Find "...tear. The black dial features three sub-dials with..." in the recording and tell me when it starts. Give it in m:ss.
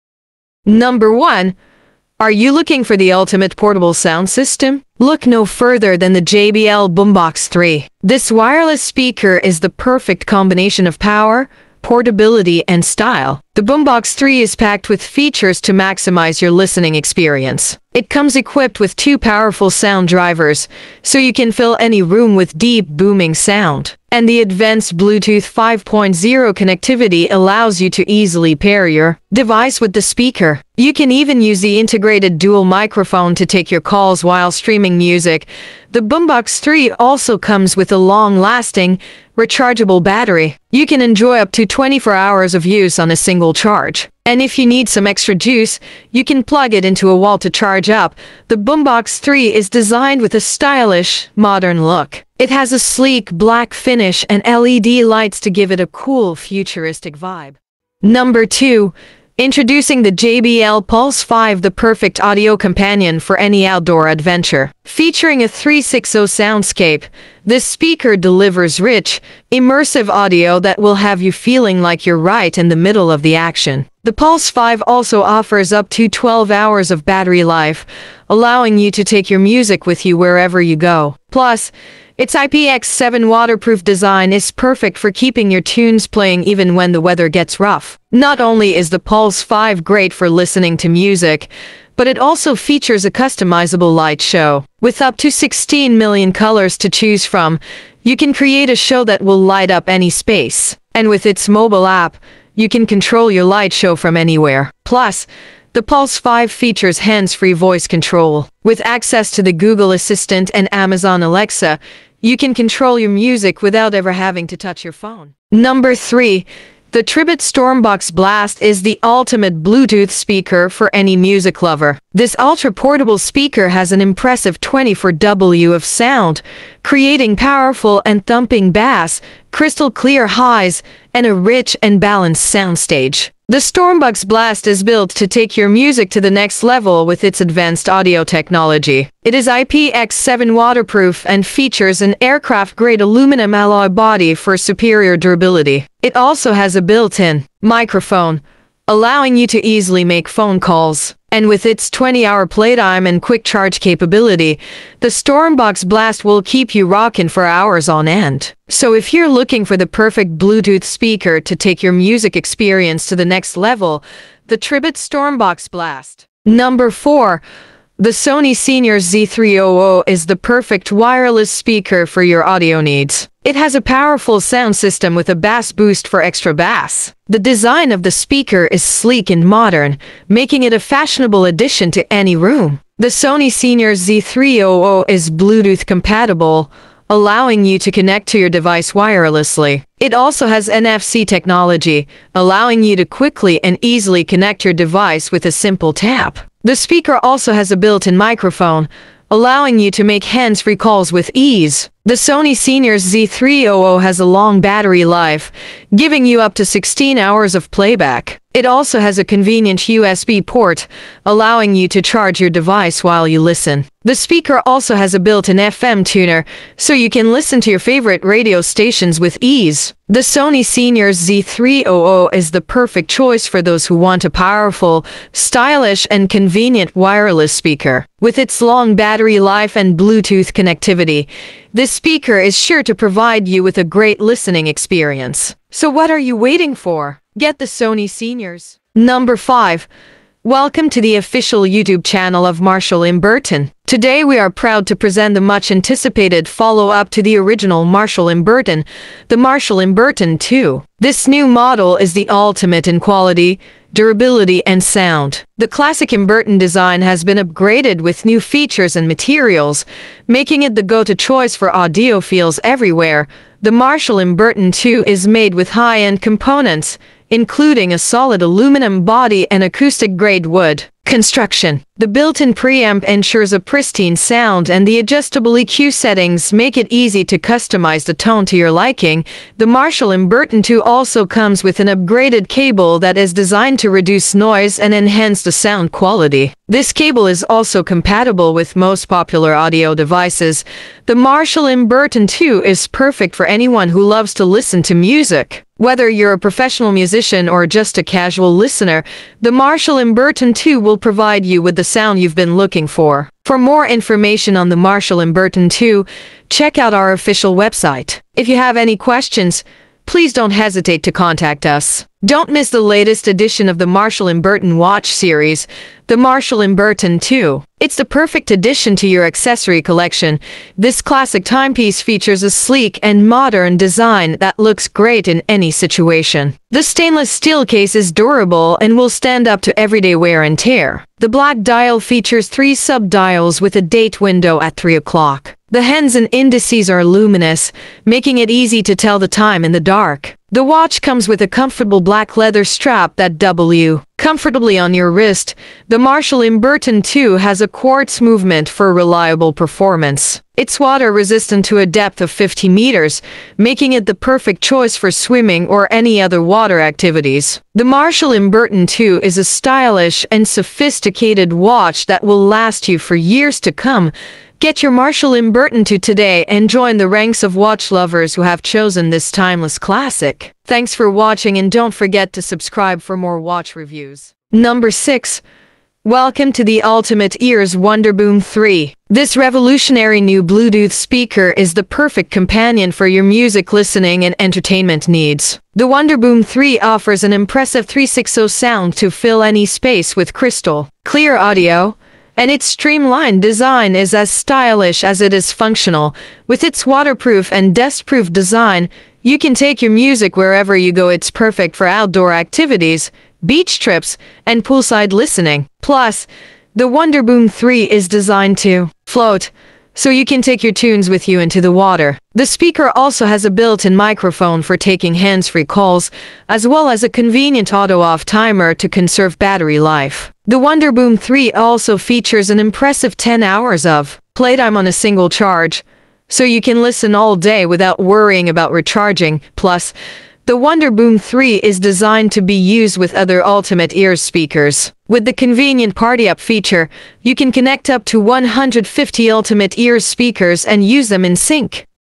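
5:30.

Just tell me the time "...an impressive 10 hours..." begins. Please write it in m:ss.
7:02.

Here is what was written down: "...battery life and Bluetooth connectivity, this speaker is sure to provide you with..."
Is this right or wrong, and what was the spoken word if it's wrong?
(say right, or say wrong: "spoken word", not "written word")
right.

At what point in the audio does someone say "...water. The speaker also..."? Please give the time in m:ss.
6:51.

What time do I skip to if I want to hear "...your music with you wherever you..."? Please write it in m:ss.
1:19.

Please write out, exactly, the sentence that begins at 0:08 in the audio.
This wireless speaker is the perfect combination of power, portability, and style.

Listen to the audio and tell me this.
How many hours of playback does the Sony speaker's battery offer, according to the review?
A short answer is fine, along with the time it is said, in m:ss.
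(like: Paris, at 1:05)
16, at 3:26.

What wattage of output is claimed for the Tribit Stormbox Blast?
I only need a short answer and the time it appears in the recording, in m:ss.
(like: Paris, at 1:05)
24W, at 2:04.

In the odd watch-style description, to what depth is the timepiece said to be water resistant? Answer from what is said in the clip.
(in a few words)
50 meters.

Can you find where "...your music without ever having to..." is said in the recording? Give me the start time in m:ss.
1:52.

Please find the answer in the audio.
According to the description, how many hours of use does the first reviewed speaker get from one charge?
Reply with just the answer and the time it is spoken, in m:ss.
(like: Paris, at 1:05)
24, at 0:41.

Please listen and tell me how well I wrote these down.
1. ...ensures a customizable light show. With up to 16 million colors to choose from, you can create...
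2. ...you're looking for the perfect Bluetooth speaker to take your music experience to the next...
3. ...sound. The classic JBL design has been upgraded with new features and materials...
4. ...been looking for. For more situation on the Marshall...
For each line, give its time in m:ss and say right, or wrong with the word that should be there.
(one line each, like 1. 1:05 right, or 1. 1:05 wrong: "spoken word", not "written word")
1. 1:32 wrong: "features", not "ensures"
2. 2:39 right
3. 4:14 wrong: "Emberton", not "JBL"
4. 5:02 wrong: "information", not "situation".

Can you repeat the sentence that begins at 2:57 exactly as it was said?
The design of the speaker is sleek and modern, making it a fashionable addition to any room.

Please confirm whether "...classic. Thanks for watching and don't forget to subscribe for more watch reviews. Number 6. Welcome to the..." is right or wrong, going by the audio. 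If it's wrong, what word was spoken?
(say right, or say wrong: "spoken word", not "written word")
right.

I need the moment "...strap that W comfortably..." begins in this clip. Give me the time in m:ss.
5:42.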